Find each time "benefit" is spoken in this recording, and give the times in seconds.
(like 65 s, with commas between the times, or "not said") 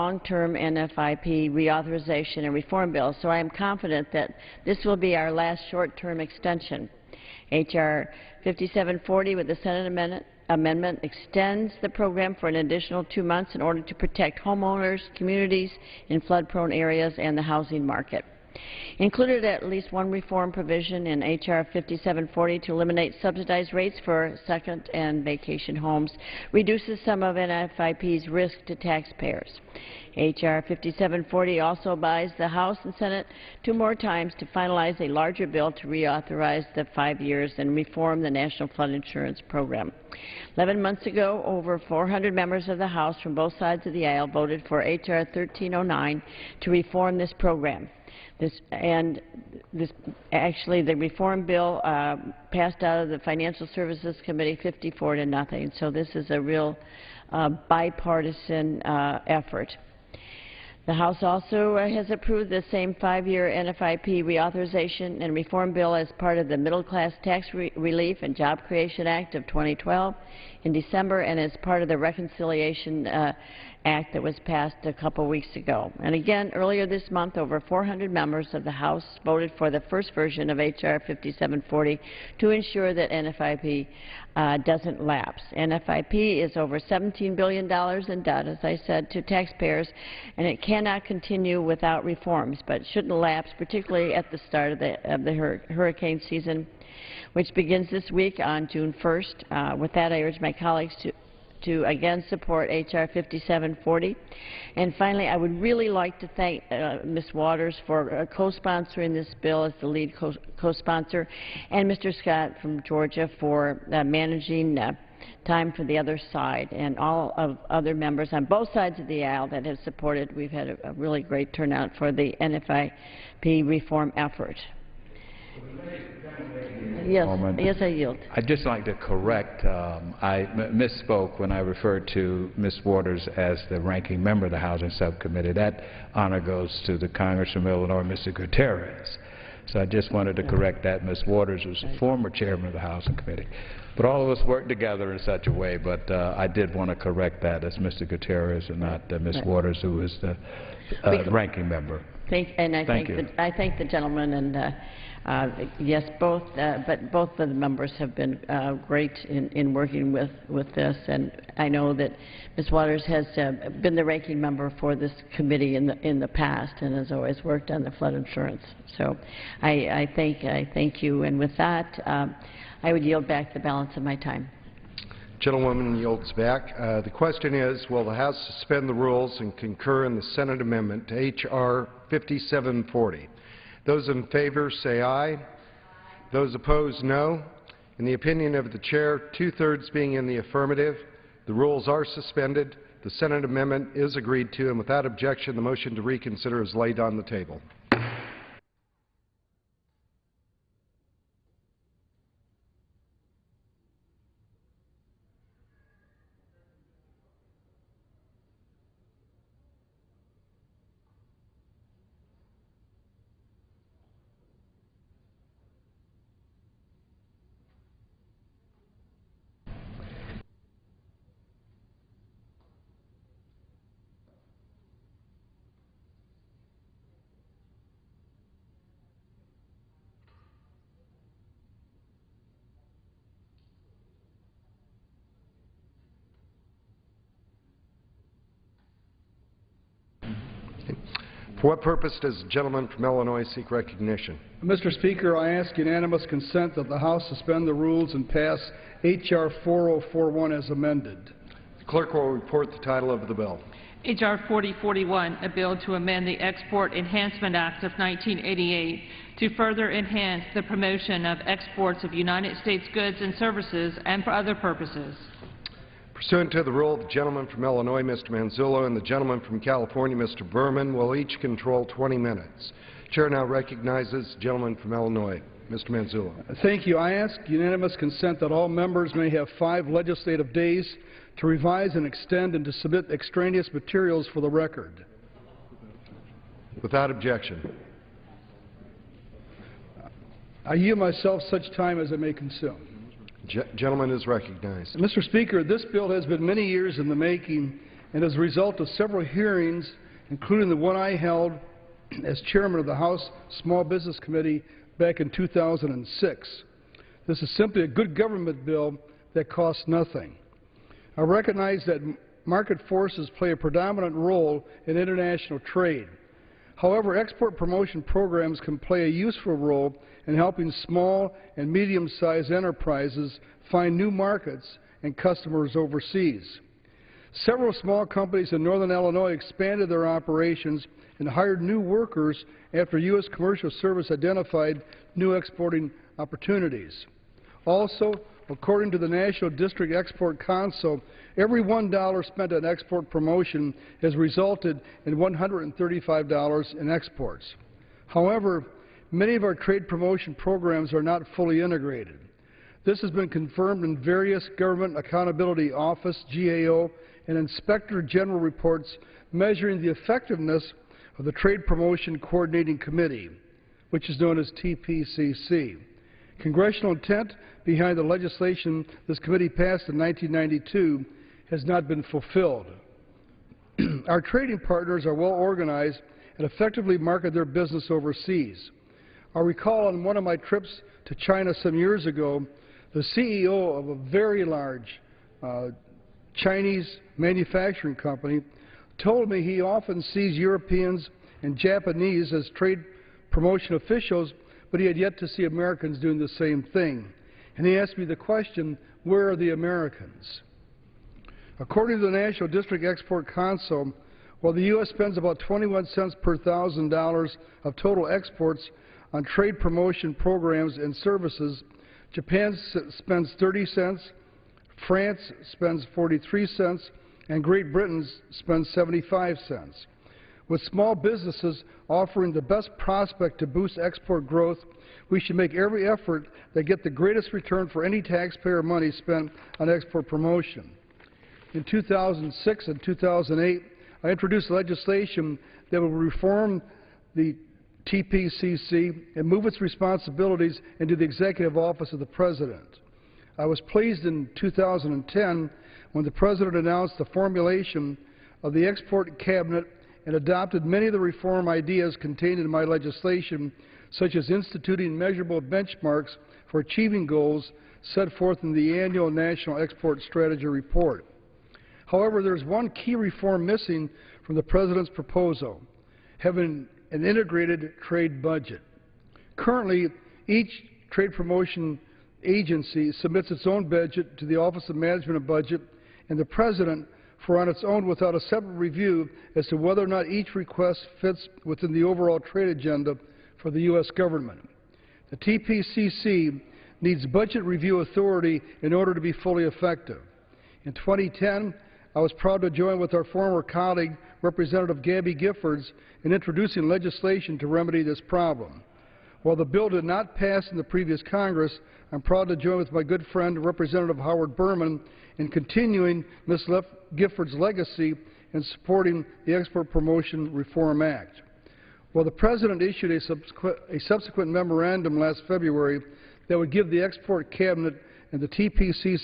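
not said.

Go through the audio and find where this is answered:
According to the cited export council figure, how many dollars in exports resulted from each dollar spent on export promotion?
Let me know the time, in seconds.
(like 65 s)
345 s.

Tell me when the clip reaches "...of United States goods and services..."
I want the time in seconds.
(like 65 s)
262 s.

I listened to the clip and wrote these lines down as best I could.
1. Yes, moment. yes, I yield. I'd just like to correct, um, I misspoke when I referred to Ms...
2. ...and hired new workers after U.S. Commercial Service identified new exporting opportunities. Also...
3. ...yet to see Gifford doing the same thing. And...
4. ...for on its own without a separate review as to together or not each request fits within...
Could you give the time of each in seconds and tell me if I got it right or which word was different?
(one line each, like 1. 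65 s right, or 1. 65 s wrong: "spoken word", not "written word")
1. 127 s right
2. 331 s right
3. 394 s wrong: "Americans", not "Gifford"
4. 477 s wrong: "whether", not "together".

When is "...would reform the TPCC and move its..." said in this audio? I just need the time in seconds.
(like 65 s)
435 s.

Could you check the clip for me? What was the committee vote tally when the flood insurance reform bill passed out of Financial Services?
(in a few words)
54 to 0.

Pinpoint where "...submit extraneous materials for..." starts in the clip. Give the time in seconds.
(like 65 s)
282 s.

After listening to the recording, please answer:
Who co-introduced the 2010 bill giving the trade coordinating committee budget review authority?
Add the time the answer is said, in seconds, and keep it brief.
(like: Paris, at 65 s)
Gabby Giffords, at 494 s.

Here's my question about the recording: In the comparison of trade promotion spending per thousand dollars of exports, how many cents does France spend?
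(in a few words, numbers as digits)
43 cents.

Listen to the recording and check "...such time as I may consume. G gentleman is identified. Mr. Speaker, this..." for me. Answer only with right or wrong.
wrong.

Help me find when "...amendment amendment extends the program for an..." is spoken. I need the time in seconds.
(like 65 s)
9 s.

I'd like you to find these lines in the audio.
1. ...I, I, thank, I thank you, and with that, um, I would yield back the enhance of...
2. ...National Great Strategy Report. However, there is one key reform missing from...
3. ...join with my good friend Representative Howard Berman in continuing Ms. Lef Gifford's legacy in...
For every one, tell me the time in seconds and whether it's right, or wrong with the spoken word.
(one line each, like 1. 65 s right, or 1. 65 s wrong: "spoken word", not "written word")
1. 169 s wrong: "balance", not "enhance"
2. 459 s wrong: "Export", not "Great"
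3. 502 s right.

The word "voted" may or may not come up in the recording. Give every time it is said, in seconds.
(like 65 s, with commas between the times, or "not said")
44 s, 79 s.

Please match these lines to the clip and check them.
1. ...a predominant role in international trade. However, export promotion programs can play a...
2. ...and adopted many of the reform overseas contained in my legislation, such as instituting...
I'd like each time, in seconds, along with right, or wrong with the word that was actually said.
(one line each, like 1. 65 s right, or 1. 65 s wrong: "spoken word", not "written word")
1. 313 s right
2. 450 s wrong: "ideas", not "overseas".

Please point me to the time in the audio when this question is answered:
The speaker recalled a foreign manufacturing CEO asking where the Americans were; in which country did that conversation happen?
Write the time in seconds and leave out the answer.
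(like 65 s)
381 s.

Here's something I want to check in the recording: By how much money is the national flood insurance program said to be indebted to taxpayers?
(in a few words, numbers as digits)
$17 billion.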